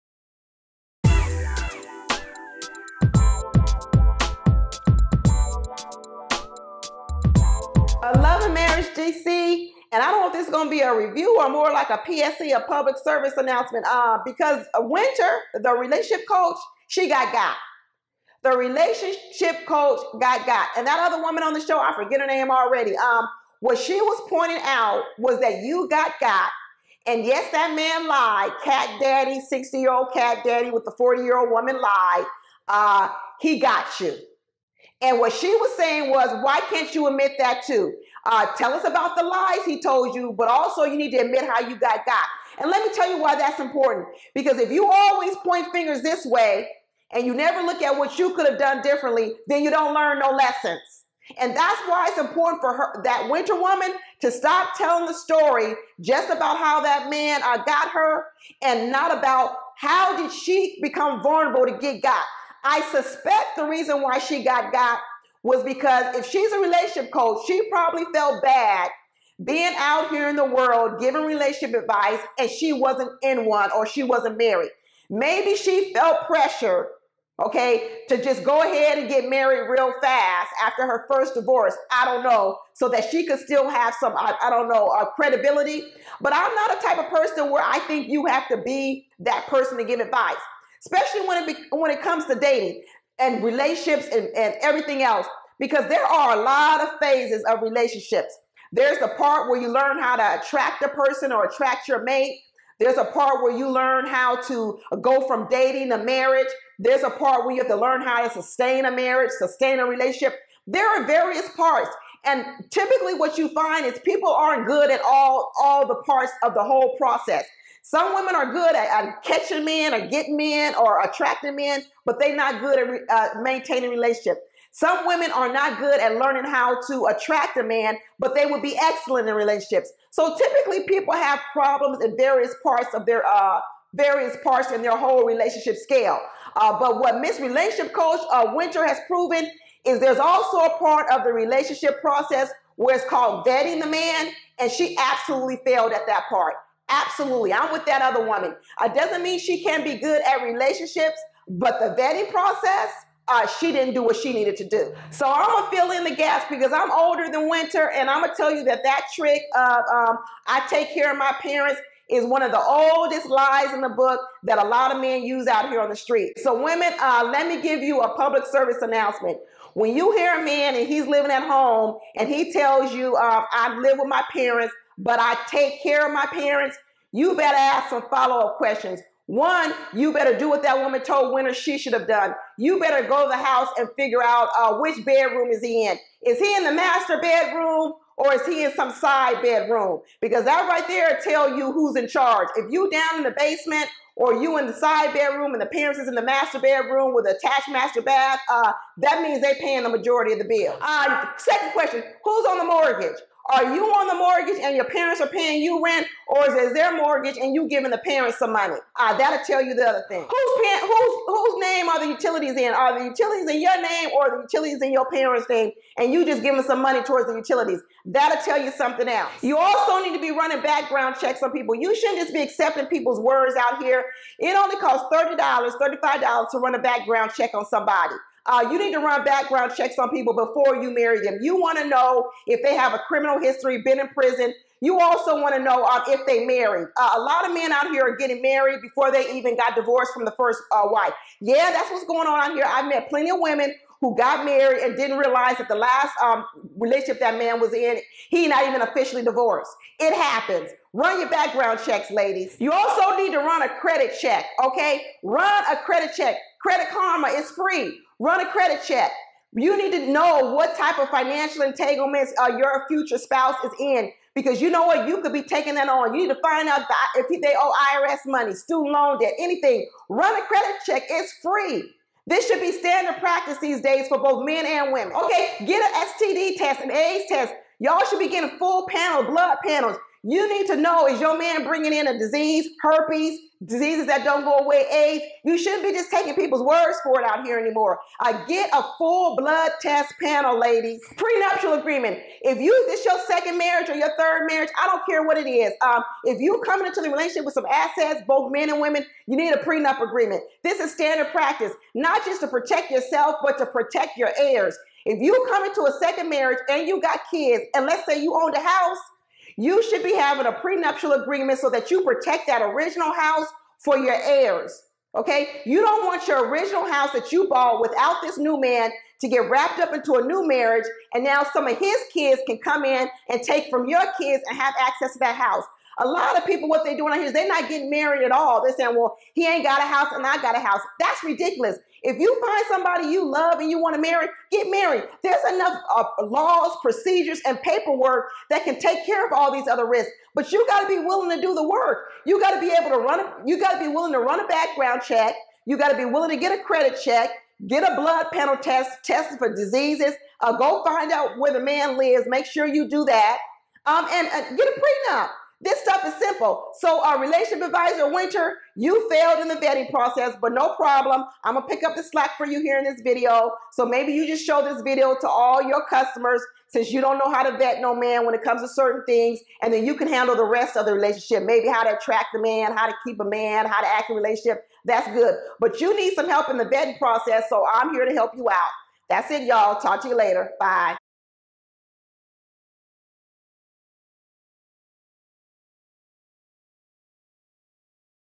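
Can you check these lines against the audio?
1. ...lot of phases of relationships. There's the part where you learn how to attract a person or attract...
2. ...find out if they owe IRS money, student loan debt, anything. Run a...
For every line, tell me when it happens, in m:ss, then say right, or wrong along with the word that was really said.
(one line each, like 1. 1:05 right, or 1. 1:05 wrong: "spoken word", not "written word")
1. 1:36 right
2. 4:26 right.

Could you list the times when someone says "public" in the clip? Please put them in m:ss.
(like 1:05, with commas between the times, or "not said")
0:12, 2:48.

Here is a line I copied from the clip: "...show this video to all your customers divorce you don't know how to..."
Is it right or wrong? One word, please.
wrong.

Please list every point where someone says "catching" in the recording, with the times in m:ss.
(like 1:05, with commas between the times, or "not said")
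1:59.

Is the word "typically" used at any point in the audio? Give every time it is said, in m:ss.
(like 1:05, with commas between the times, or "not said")
1:52, 2:10.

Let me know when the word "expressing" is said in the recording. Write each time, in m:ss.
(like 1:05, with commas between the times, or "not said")
not said.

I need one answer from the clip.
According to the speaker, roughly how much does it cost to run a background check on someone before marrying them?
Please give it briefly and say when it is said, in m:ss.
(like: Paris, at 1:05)
$30 to $35, at 3:45.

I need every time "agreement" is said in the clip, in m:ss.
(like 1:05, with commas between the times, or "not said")
4:51, 5:00, 5:11.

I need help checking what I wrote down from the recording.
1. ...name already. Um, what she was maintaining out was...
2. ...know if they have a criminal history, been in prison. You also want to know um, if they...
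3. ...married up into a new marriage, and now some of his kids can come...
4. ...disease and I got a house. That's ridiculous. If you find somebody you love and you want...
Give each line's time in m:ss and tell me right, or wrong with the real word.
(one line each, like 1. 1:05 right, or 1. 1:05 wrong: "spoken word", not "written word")
1. 0:22 wrong: "pointing", not "maintaining"
2. 3:51 right
3. 5:19 wrong: "wrapped", not "married"
4. 5:29 wrong: "house", not "disease".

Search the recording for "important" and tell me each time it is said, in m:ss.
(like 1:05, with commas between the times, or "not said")
0:43, 0:52.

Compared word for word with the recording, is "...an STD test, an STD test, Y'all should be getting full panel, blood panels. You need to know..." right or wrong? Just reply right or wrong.
wrong.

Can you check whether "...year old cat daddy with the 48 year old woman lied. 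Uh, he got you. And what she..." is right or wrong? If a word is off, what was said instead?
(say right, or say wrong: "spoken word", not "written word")
wrong: "40", not "48".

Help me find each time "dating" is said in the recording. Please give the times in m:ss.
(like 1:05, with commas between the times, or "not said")
1:32, 1:45.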